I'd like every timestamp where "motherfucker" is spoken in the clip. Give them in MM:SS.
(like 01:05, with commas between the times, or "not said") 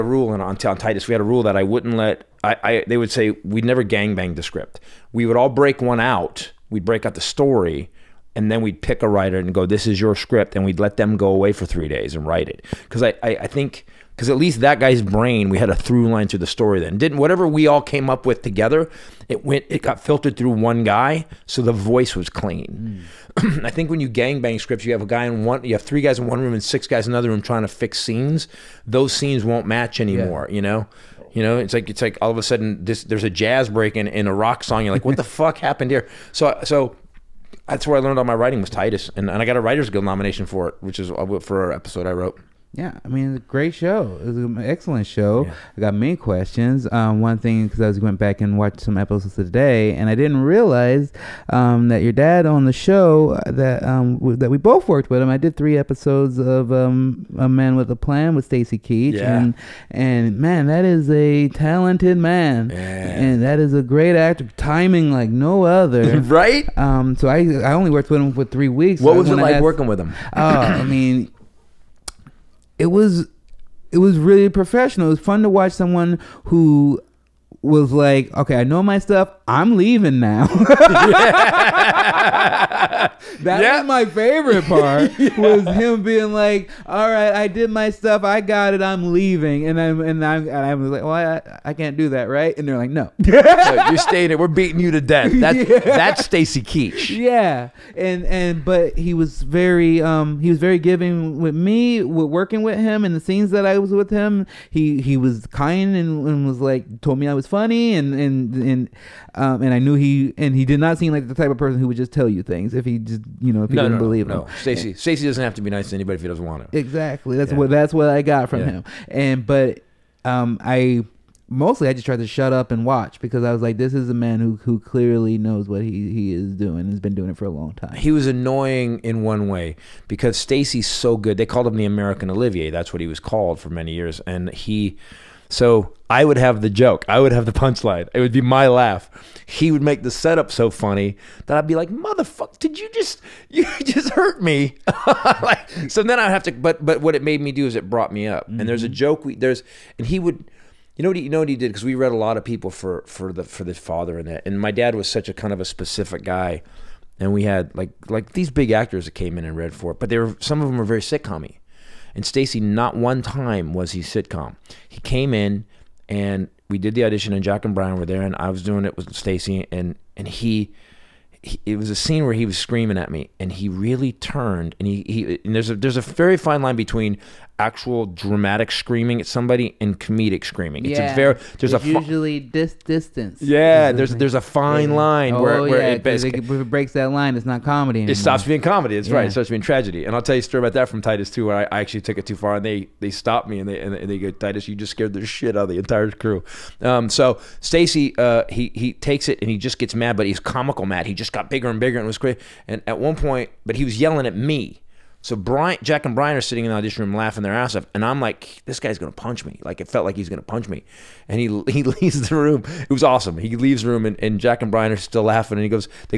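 02:21.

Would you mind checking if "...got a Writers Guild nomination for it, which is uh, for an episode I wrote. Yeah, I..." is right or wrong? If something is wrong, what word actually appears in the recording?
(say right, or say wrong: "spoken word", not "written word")
right.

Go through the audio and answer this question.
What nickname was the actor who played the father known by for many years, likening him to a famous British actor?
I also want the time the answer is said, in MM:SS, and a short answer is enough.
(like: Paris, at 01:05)
The American Olivier, at 02:11.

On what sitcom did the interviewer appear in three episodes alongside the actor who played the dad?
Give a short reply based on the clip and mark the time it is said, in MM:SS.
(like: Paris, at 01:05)
A Man with a Plan, at 00:57.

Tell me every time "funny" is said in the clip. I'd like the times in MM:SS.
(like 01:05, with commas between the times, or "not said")
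01:47, 02:20.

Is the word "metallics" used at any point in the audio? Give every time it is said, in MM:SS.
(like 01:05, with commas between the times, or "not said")
not said.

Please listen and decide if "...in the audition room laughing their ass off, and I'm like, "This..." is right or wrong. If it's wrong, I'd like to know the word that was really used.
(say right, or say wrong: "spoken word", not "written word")
right.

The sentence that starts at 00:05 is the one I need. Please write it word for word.
We would all break one out.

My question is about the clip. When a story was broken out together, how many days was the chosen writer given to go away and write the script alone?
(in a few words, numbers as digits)
3.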